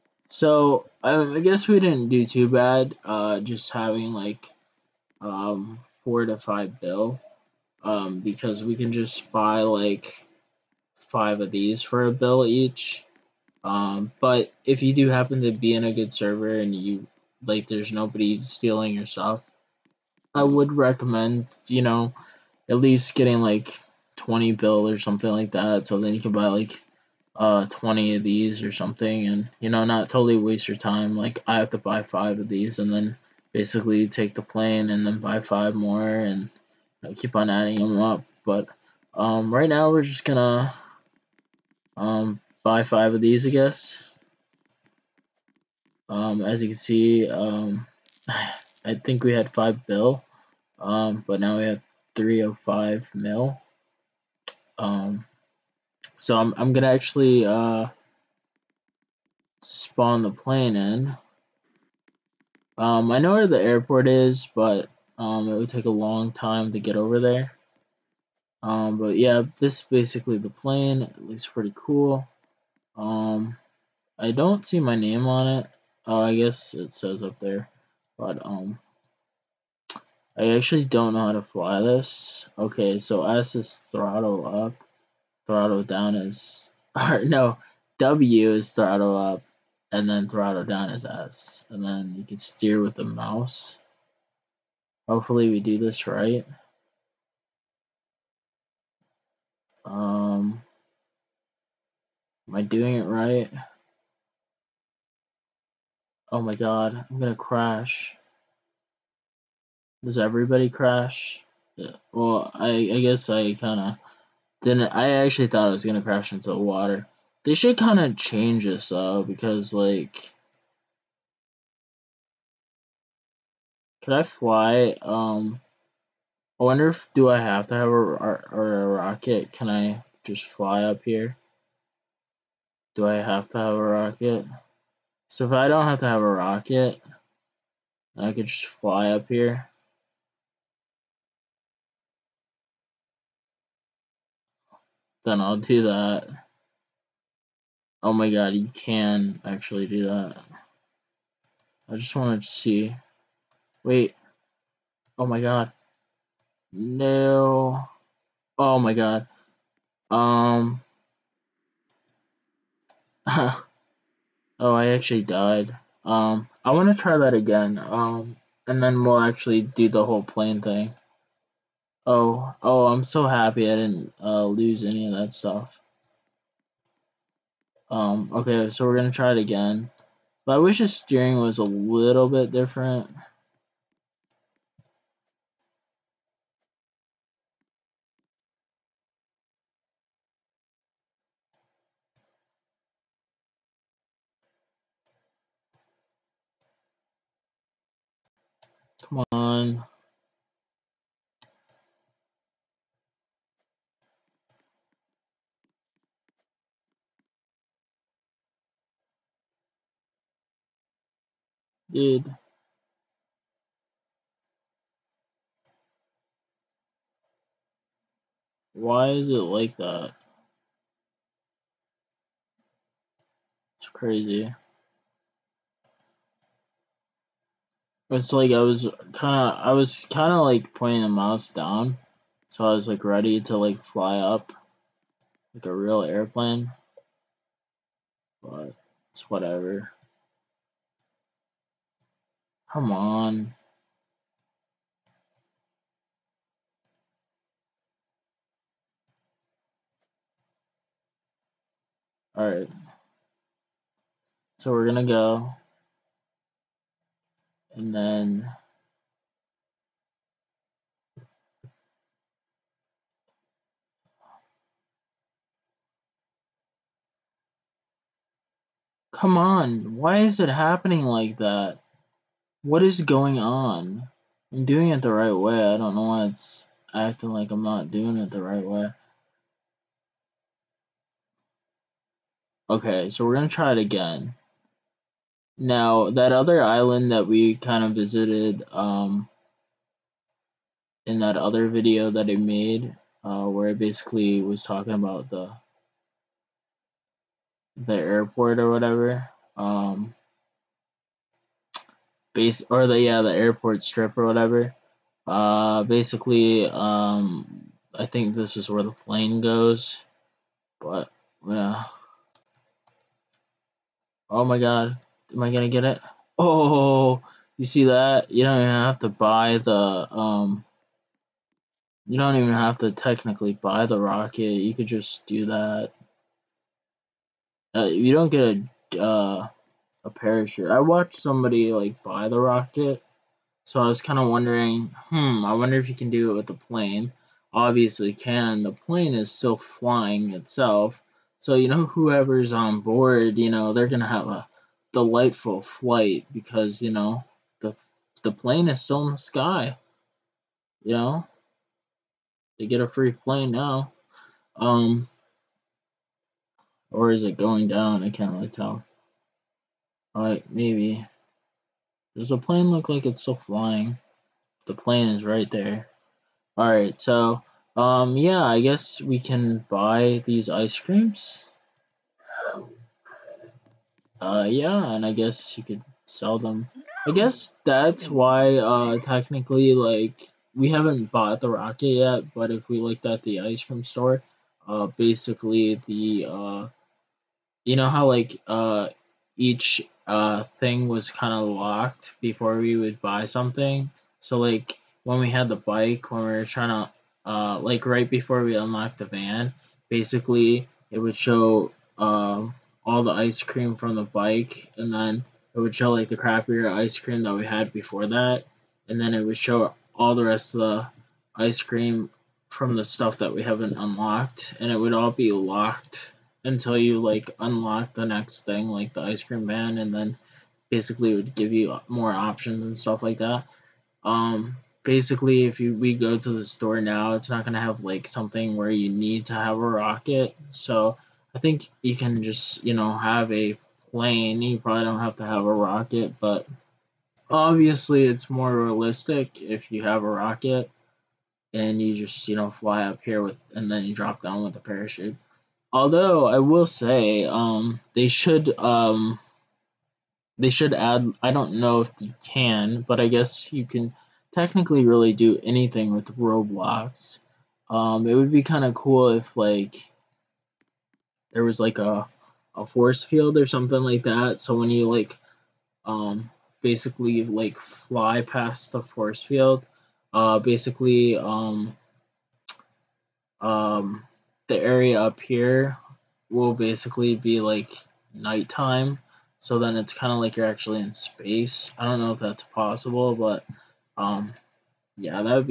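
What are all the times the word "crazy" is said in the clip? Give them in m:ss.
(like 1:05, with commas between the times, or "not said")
3:43.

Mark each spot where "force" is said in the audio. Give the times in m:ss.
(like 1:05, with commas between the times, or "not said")
7:42, 7:48.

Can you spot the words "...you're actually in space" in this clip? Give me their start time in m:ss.
8:00.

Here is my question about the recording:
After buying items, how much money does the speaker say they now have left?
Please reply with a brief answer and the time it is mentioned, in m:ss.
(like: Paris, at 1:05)
305 mil, at 0:52.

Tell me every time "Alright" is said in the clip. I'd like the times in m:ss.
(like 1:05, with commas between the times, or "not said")
4:12, 6:00, 6:06.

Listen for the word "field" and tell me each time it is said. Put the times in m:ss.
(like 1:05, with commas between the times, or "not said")
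7:43, 7:49.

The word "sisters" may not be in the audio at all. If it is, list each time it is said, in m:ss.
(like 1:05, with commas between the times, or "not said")
not said.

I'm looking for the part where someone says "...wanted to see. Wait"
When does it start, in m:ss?
2:32.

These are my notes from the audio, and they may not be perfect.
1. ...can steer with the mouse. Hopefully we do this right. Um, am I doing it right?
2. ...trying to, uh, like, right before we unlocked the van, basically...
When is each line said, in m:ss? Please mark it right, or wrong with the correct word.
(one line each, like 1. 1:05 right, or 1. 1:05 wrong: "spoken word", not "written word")
1. 1:32 right
2. 6:36 right.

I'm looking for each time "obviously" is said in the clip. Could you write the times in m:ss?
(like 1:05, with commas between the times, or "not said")
5:37, 7:17.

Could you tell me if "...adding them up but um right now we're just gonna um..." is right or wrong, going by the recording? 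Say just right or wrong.
right.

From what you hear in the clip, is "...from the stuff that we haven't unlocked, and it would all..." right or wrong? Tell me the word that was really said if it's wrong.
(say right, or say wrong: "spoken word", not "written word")
right.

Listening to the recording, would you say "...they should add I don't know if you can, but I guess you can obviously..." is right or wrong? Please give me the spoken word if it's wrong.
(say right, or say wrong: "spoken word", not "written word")
wrong: "technically", not "obviously".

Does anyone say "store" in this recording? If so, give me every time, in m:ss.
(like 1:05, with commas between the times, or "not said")
6:23, 7:06.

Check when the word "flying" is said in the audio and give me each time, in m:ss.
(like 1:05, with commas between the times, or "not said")
5:39, 6:03.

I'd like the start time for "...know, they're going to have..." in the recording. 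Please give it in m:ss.
5:43.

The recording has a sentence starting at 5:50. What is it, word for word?
You know, they get a free plane now.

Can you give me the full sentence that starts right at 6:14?
Uh, yeah, and I guess you could sell them.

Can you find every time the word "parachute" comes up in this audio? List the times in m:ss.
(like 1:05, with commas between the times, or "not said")
5:30, 7:24.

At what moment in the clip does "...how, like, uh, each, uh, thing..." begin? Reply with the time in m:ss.
6:27.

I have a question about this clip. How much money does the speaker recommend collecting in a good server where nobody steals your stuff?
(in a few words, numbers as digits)
20 bill.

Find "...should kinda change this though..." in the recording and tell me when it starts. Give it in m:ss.
1:57.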